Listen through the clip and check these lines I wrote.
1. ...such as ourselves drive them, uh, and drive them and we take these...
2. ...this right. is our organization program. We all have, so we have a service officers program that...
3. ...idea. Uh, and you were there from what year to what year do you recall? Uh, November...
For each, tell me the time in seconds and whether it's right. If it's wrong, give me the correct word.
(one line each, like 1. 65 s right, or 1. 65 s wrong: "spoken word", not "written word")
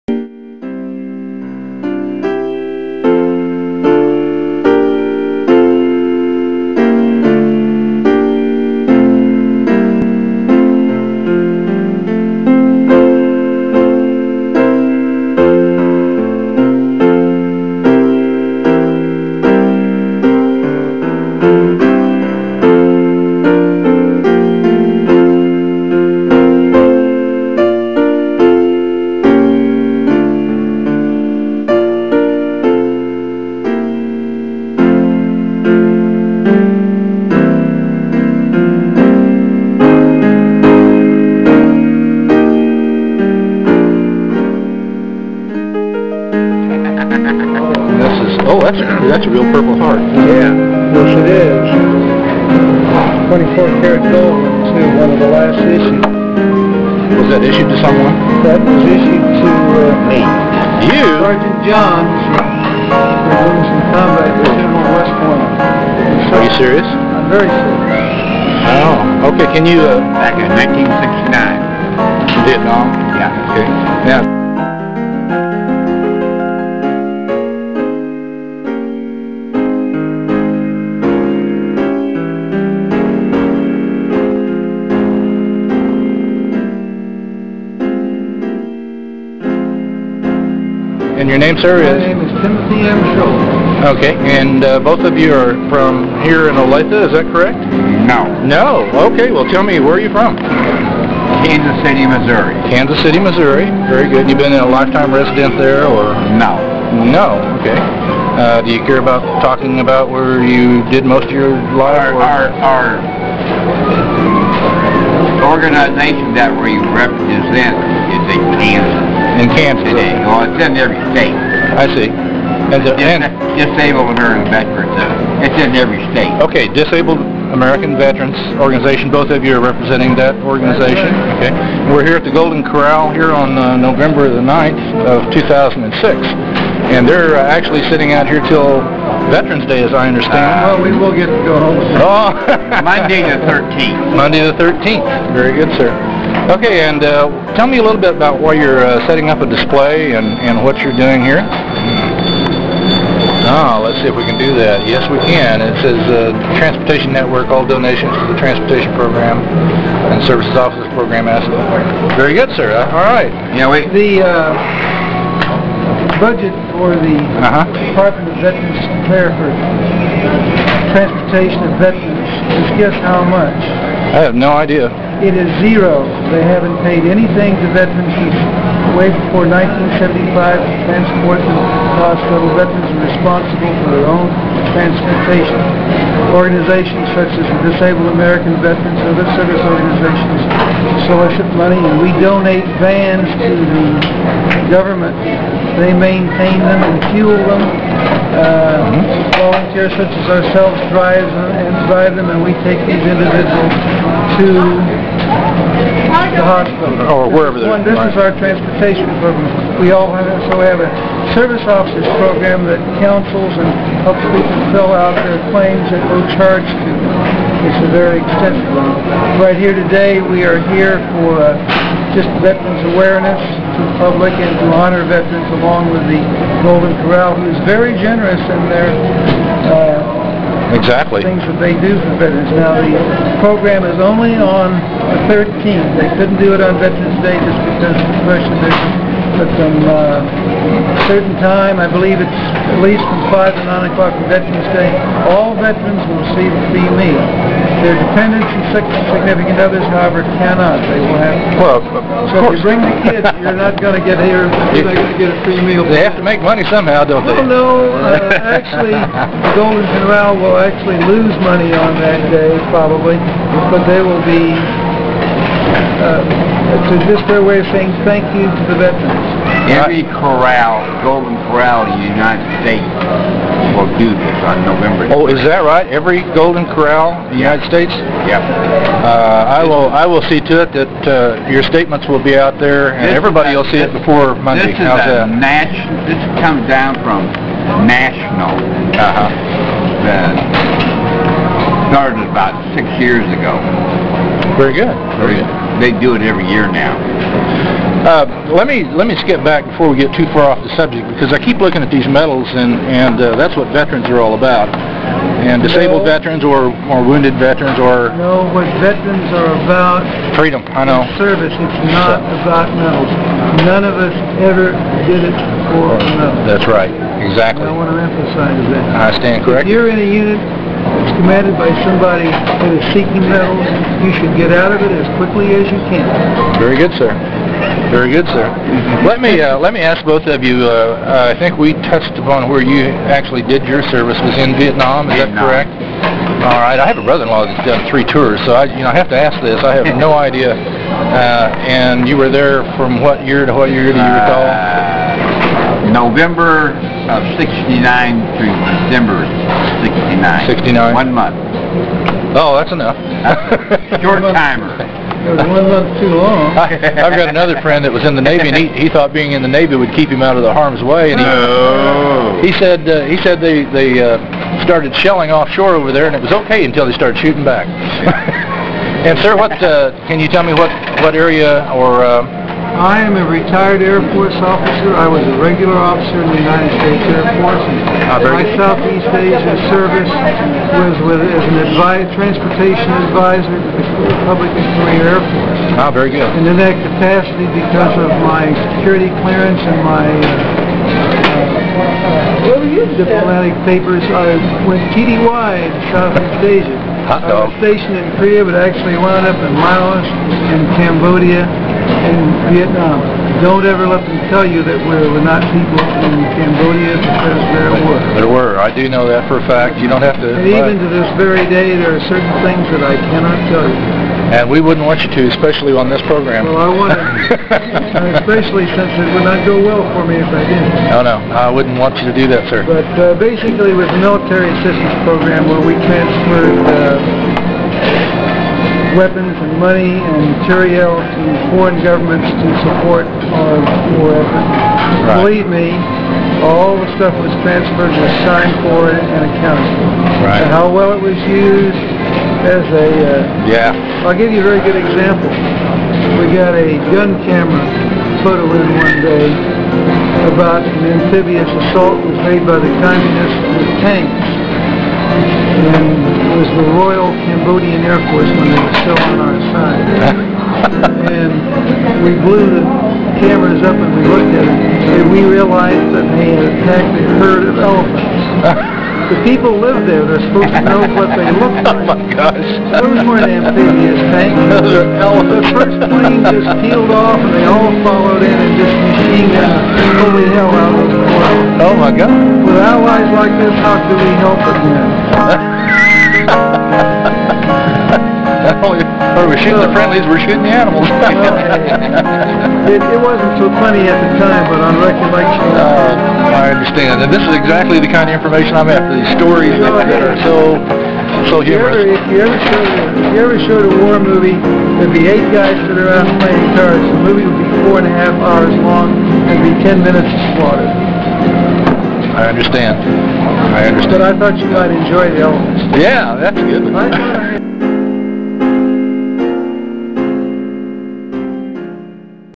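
1. 200 s right
2. 207 s wrong: "transportation", not "organization"
3. 340 s right.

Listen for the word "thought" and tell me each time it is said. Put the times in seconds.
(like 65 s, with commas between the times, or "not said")
358 s, 514 s.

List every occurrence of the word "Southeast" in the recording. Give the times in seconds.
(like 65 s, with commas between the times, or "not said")
378 s, 395 s.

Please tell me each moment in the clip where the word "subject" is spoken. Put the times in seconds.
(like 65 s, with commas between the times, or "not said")
300 s.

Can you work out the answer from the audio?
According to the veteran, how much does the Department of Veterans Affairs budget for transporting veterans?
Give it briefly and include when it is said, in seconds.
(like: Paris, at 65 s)
Zero, at 175 s.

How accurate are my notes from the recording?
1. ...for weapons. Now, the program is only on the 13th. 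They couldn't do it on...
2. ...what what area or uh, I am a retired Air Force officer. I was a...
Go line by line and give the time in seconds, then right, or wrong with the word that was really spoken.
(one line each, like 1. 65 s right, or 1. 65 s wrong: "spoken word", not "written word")
1. 231 s wrong: "veterans", not "weapons"
2. 370 s right.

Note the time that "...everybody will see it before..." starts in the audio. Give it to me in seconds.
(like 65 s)
283 s.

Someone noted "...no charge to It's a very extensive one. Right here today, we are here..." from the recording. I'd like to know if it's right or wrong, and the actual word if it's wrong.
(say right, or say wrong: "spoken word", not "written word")
right.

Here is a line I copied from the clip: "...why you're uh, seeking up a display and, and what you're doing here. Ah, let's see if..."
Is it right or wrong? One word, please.
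wrong.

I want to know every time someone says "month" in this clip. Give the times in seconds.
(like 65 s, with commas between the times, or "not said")
351 s, 355 s.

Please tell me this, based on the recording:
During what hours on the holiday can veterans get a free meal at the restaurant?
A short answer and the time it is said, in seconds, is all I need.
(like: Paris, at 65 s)
5 to 9 o'clock, at 243 s.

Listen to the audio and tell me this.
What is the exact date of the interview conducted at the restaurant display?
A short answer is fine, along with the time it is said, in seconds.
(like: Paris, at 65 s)
November 9, 2006, at 133 s.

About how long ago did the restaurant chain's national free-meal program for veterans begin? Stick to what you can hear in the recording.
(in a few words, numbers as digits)
About six years ago.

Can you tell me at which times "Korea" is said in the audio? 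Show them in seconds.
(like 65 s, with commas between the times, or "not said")
384 s, 398 s.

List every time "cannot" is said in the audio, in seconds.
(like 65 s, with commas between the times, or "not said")
250 s, 413 s.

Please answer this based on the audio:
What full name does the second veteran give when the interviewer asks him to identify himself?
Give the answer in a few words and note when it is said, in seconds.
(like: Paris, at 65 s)
Timothy M. Schultz, at 92 s.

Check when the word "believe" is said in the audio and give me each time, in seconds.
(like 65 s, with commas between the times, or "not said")
241 s, 435 s.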